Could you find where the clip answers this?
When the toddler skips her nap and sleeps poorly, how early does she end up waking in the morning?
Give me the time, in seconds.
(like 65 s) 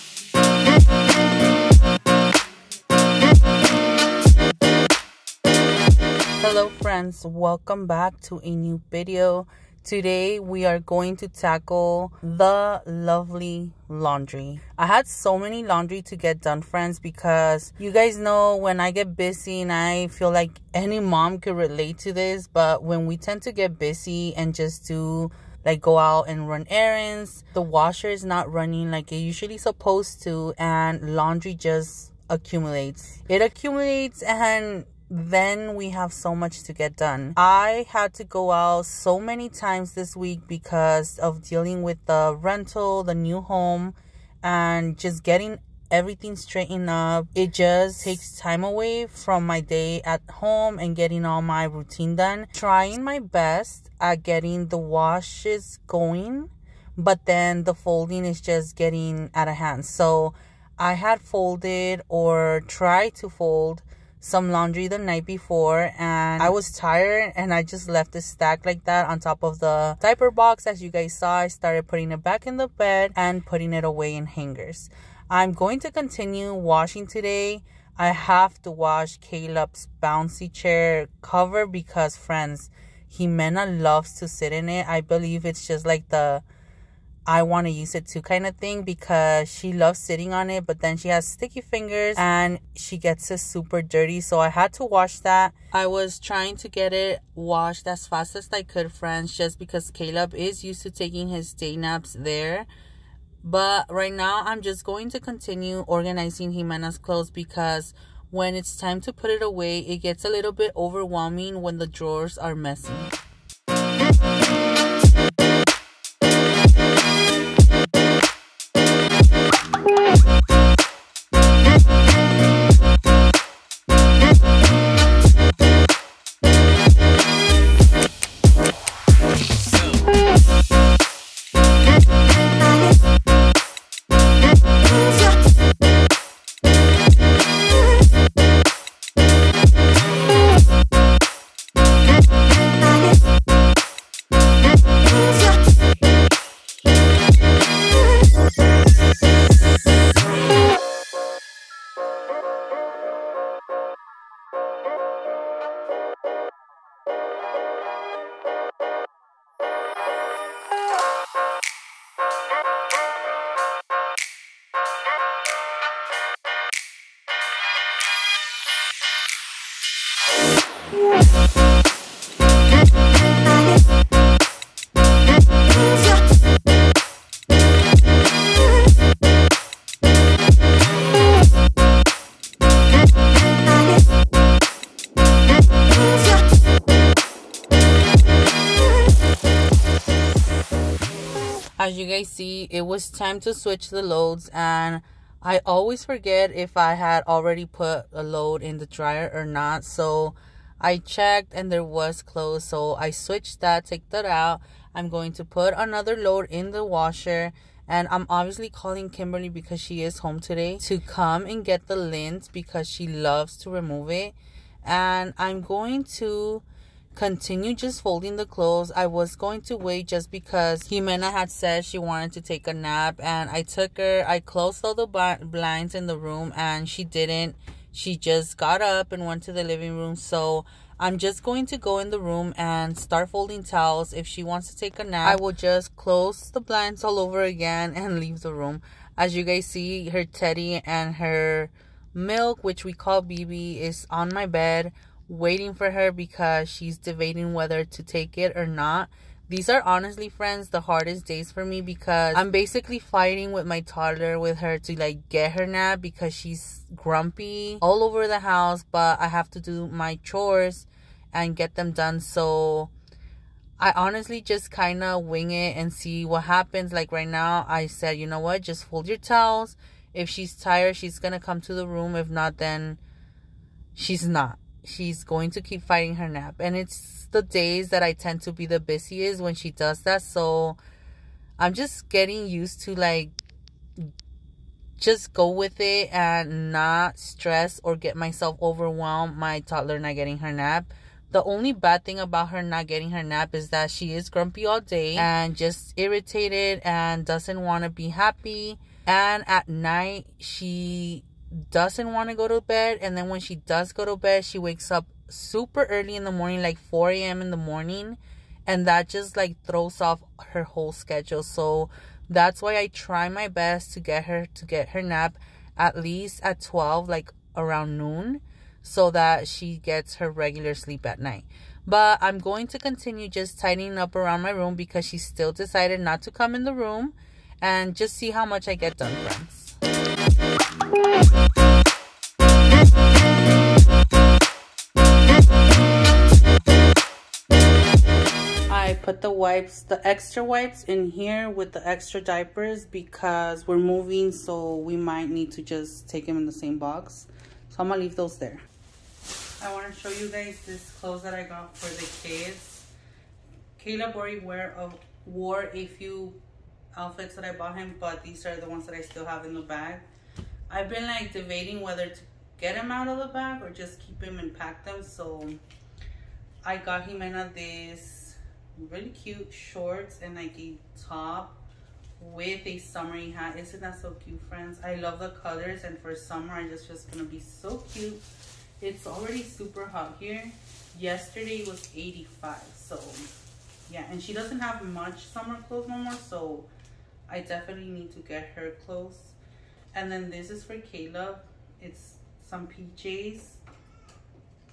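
306 s.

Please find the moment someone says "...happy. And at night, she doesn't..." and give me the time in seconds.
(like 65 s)
298 s.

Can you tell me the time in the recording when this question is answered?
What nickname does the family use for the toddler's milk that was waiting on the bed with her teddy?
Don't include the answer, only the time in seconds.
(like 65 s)
243 s.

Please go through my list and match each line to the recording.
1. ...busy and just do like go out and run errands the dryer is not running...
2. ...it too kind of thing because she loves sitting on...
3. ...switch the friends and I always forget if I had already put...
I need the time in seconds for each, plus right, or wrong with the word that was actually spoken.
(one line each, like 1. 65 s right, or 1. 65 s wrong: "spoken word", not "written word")
1. 23 s wrong: "washer", not "dryer"
2. 87 s right
3. 193 s wrong: "loads", not "friends".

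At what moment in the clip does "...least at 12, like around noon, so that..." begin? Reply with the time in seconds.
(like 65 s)
316 s.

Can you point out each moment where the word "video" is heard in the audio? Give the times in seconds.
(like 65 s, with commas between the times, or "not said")
8 s.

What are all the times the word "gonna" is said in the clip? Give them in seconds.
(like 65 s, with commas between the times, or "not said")
347 s, 377 s.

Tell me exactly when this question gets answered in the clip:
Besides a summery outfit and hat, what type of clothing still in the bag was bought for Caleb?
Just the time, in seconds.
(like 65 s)
392 s.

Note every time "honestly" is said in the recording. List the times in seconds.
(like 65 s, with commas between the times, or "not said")
249 s, 263 s.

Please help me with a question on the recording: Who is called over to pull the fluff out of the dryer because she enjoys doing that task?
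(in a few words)
Kimberly.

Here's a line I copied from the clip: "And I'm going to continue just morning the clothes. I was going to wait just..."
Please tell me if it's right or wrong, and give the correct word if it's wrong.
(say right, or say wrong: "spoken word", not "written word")
wrong: "folding", not "morning".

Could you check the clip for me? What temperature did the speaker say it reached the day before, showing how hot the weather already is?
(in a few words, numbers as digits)
85.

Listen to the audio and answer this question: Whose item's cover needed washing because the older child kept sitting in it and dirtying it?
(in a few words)
Caleb's bouncy chair.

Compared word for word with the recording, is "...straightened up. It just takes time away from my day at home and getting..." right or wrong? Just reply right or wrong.
right.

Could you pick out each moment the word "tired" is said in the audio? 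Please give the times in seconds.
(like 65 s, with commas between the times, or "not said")
66 s, 270 s.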